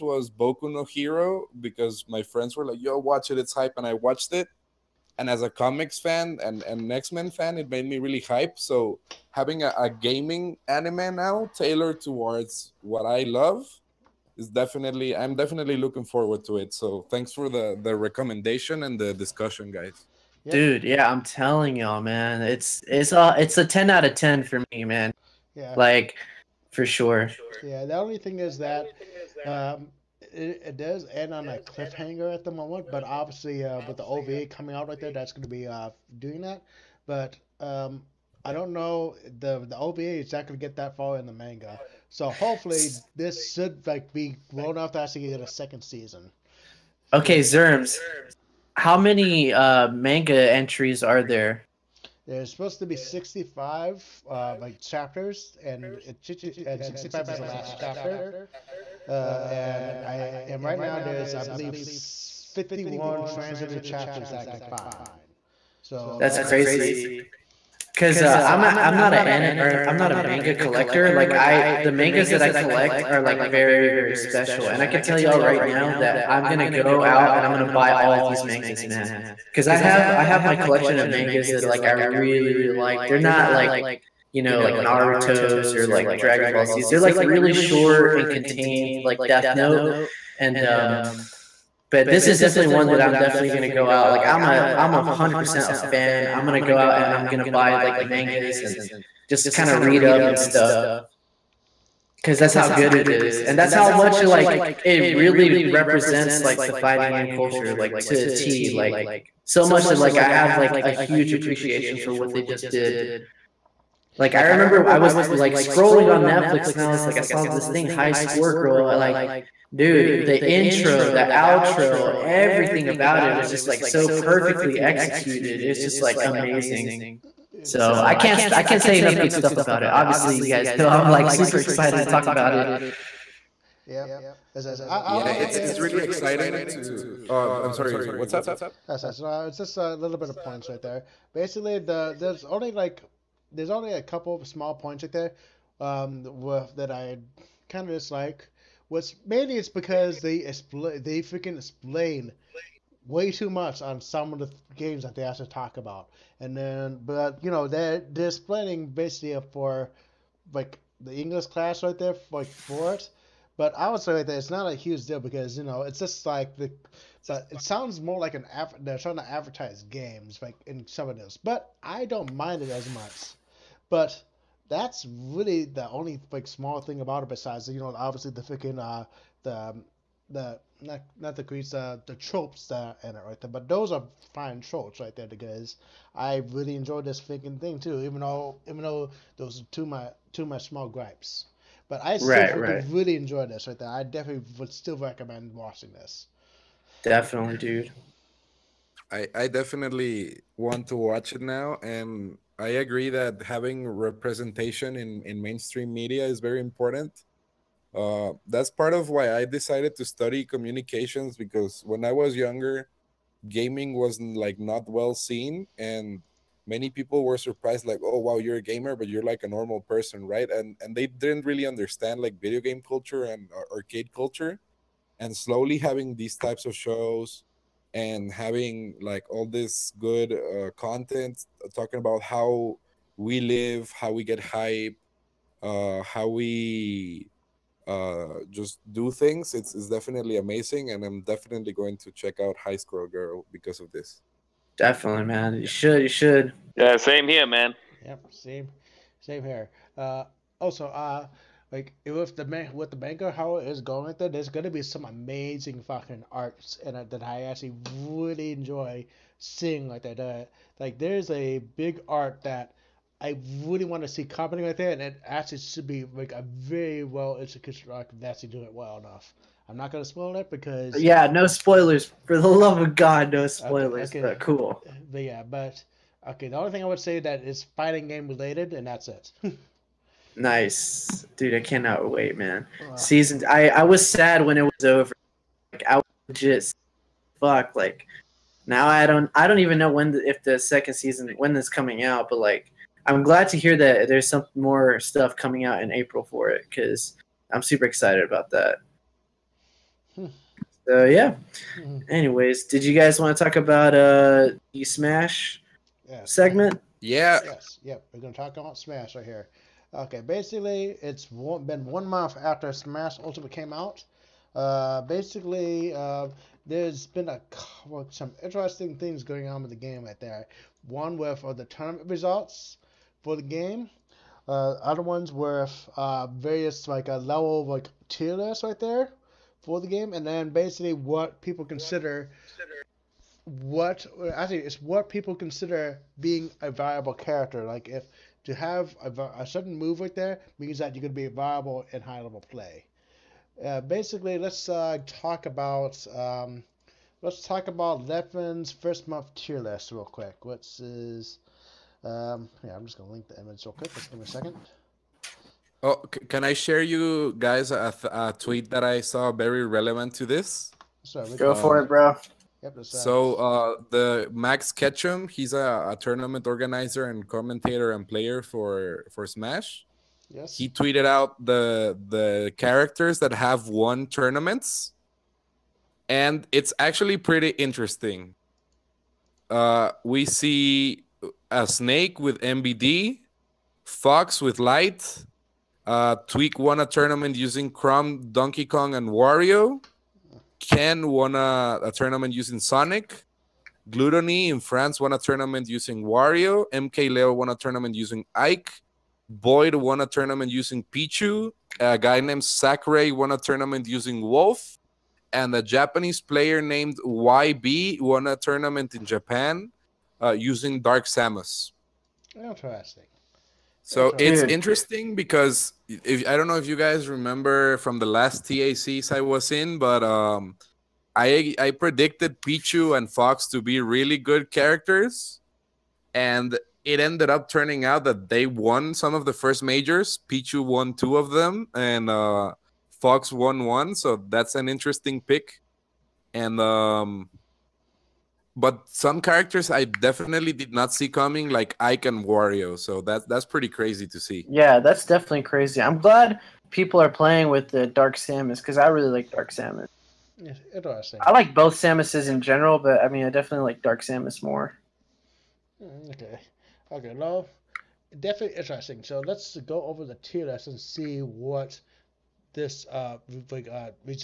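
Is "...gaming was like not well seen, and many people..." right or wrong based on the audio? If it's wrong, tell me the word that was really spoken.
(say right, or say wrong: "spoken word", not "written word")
right.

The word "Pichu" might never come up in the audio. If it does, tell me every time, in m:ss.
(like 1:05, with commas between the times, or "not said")
6:40, 7:02, 7:10.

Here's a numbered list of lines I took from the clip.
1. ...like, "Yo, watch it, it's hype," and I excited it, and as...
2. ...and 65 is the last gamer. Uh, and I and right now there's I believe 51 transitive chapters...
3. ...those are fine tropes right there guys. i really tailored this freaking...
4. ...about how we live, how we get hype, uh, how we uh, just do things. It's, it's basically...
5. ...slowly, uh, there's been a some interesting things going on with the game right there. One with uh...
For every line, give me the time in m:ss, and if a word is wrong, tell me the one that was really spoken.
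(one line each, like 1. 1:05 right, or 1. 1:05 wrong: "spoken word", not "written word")
1. 0:02 wrong: "watched", not "excited"
2. 0:56 wrong: "chapter", not "gamer"
3. 3:03 wrong: "enjoyed", not "tailored"
4. 3:51 wrong: "definitely", not "basically"
5. 5:15 wrong: "basically", not "slowly".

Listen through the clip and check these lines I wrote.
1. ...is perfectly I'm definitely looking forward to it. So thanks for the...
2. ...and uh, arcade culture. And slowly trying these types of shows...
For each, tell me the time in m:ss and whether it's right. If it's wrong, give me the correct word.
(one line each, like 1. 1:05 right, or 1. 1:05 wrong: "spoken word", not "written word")
1. 0:14 wrong: "definitely", not "perfectly"
2. 3:43 wrong: "having", not "trying".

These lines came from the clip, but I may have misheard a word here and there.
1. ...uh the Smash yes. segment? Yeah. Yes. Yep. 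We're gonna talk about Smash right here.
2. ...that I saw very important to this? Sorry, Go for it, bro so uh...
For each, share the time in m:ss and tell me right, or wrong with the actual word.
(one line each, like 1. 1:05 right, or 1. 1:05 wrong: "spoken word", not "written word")
1. 5:03 right
2. 5:58 wrong: "relevant", not "important".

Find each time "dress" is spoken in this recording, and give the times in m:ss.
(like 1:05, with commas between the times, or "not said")
not said.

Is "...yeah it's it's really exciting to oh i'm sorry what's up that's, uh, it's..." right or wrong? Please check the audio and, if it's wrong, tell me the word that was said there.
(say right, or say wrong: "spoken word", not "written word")
right.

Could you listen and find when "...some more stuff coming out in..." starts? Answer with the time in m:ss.
4:54.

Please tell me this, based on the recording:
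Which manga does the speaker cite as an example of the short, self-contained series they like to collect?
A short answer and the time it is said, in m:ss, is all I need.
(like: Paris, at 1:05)
Death Note, at 1:29.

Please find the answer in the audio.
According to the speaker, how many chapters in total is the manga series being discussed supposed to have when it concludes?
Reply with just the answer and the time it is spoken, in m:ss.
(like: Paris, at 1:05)
65, at 0:52.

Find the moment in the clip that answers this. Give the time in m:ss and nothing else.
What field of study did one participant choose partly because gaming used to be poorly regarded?
3:30.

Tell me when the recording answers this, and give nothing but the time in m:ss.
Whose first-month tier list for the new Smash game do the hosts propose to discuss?
5:48.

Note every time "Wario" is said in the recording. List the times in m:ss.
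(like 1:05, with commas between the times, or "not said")
6:29, 6:36, 7:22.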